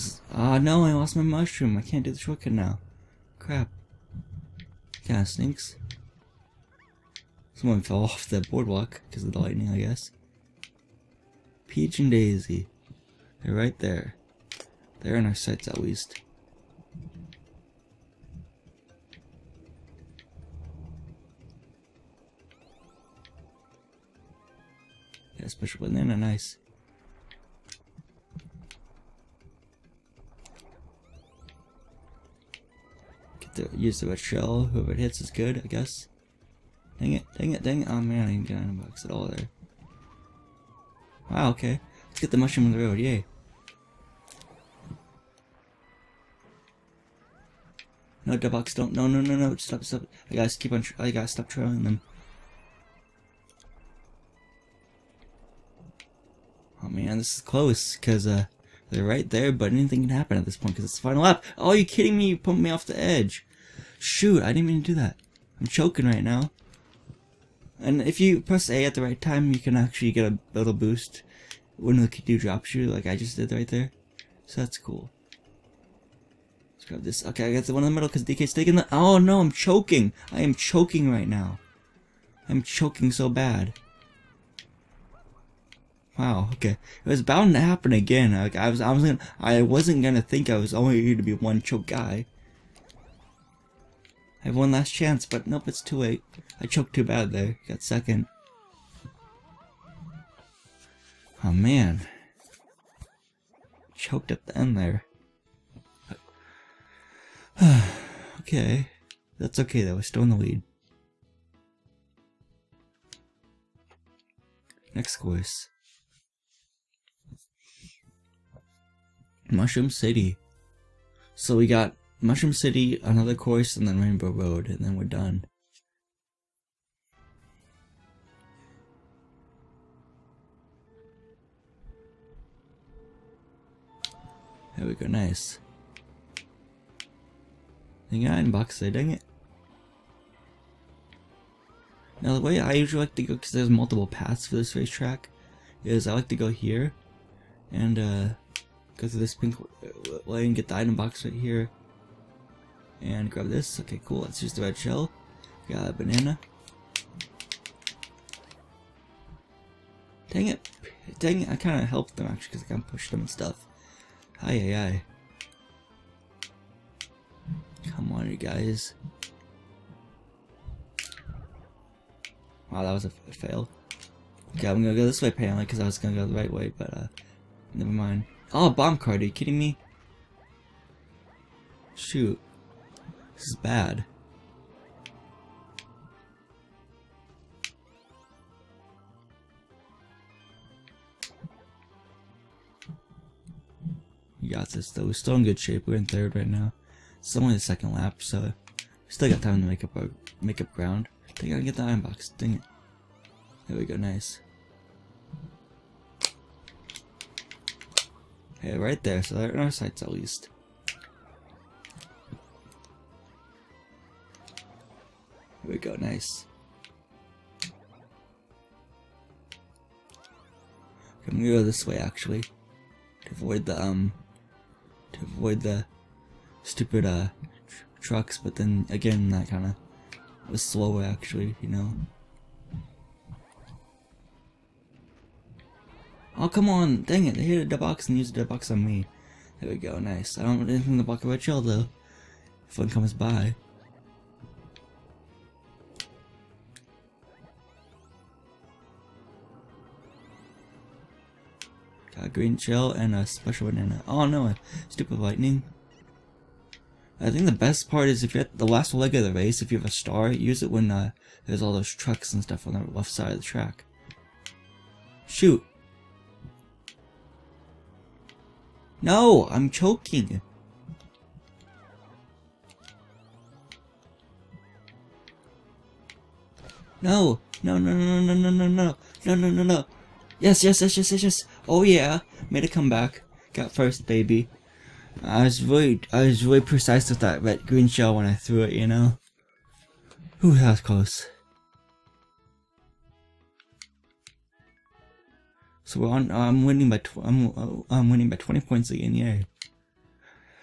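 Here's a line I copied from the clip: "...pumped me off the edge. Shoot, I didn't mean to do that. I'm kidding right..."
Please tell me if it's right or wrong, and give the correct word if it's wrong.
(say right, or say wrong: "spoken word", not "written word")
wrong: "choking", not "kidding".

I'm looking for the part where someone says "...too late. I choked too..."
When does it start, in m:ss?
1:35.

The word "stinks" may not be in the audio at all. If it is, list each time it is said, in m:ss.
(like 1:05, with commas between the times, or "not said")
0:05.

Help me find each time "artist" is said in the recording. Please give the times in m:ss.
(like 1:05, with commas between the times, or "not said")
not said.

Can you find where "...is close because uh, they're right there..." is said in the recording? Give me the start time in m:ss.
0:57.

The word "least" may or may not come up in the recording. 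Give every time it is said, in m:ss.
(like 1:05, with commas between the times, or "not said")
0:15, 3:30.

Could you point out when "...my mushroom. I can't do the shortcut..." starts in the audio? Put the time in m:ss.
0:01.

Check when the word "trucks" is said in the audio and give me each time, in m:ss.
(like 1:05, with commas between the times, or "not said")
3:48, 4:21.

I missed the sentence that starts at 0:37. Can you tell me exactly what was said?
Oh man, I didn't get 9 bucks at all there.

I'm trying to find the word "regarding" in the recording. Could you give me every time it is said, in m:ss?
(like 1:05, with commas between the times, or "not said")
not said.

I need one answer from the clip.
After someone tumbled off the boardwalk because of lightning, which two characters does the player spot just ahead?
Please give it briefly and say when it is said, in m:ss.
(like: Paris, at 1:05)
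Peach and Daisy, at 0:11.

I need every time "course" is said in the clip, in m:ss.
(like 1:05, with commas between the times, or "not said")
1:55, 2:03.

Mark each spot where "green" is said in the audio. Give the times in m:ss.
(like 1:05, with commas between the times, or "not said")
4:12, 4:47.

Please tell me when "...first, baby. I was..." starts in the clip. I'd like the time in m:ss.
4:43.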